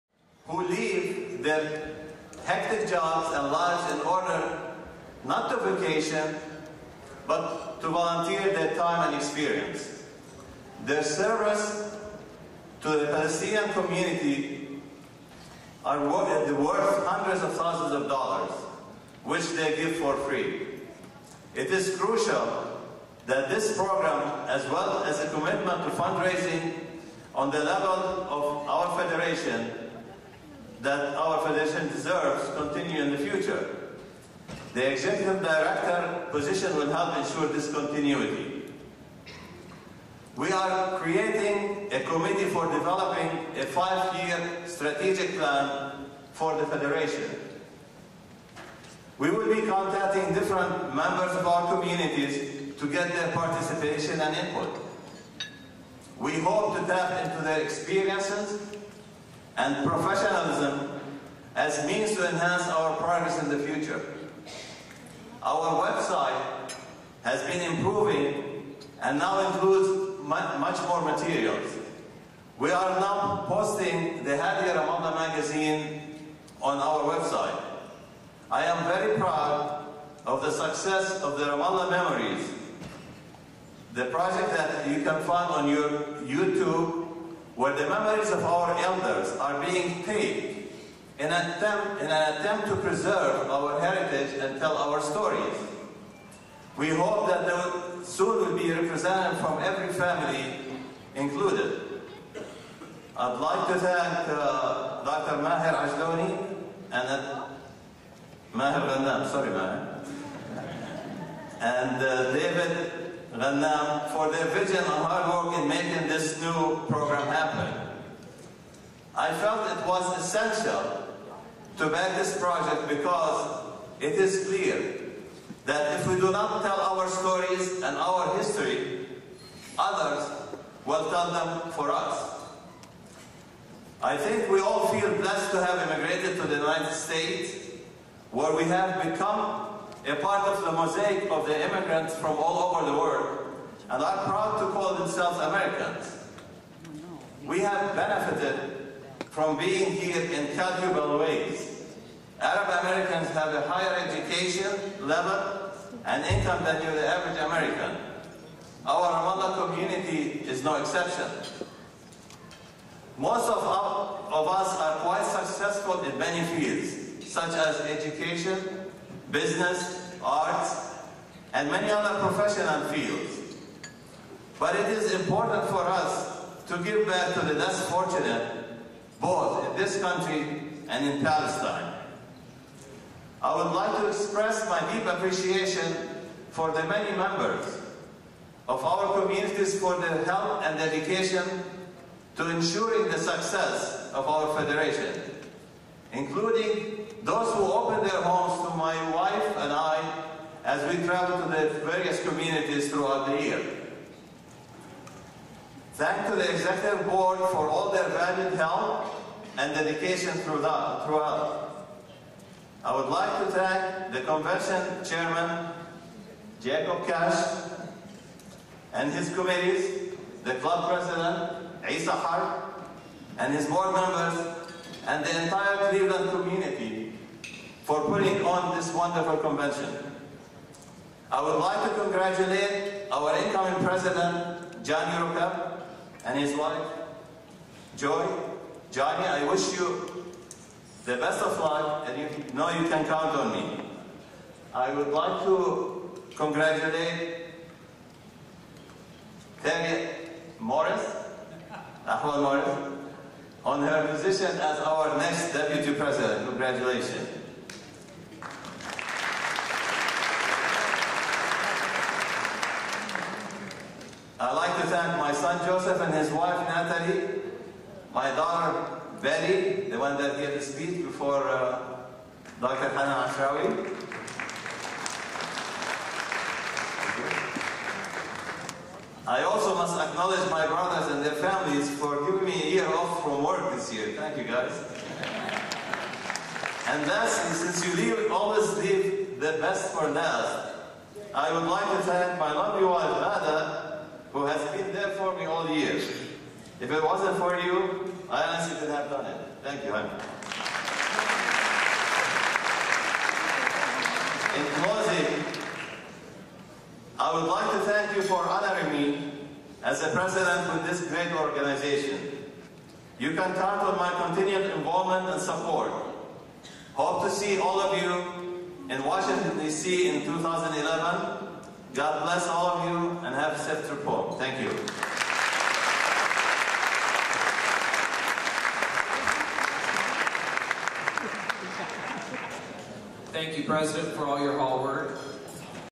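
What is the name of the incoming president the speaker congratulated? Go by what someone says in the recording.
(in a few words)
John Yuruka.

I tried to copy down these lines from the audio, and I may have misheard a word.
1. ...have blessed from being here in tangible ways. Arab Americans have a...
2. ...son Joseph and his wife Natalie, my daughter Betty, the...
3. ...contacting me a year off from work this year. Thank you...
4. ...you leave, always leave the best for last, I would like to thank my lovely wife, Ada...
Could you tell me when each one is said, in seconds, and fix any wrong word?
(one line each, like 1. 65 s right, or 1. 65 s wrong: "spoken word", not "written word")
1. 147 s wrong: "benefited", not "blessed"
2. 265 s right
3. 282 s wrong: "giving", not "contacting"
4. 287 s right.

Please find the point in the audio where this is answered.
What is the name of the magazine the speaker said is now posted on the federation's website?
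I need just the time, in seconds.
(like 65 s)
74 s.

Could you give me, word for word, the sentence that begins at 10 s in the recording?
Their service to the Palestinian community are worth hundreds of thousands of dollars, which they give for free.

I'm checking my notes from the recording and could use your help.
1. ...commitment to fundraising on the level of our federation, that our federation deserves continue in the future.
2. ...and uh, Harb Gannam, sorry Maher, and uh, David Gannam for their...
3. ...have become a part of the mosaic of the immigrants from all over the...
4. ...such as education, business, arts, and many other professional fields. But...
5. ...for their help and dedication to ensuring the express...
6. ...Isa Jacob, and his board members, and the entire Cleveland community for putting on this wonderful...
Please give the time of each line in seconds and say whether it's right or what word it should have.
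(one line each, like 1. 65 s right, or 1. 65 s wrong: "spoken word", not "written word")
1. 25 s right
2. 106 s wrong: "Maher", not "Harb"
3. 138 s right
4. 167 s right
5. 189 s wrong: "success", not "express"
6. 221 s wrong: "Harb", not "Jacob".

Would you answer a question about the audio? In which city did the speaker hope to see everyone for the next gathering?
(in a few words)
Washington, D.C.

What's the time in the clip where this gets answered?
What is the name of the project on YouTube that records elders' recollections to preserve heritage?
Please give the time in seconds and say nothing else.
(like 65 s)
81 s.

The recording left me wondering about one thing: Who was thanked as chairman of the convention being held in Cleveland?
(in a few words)
Jacob Cash.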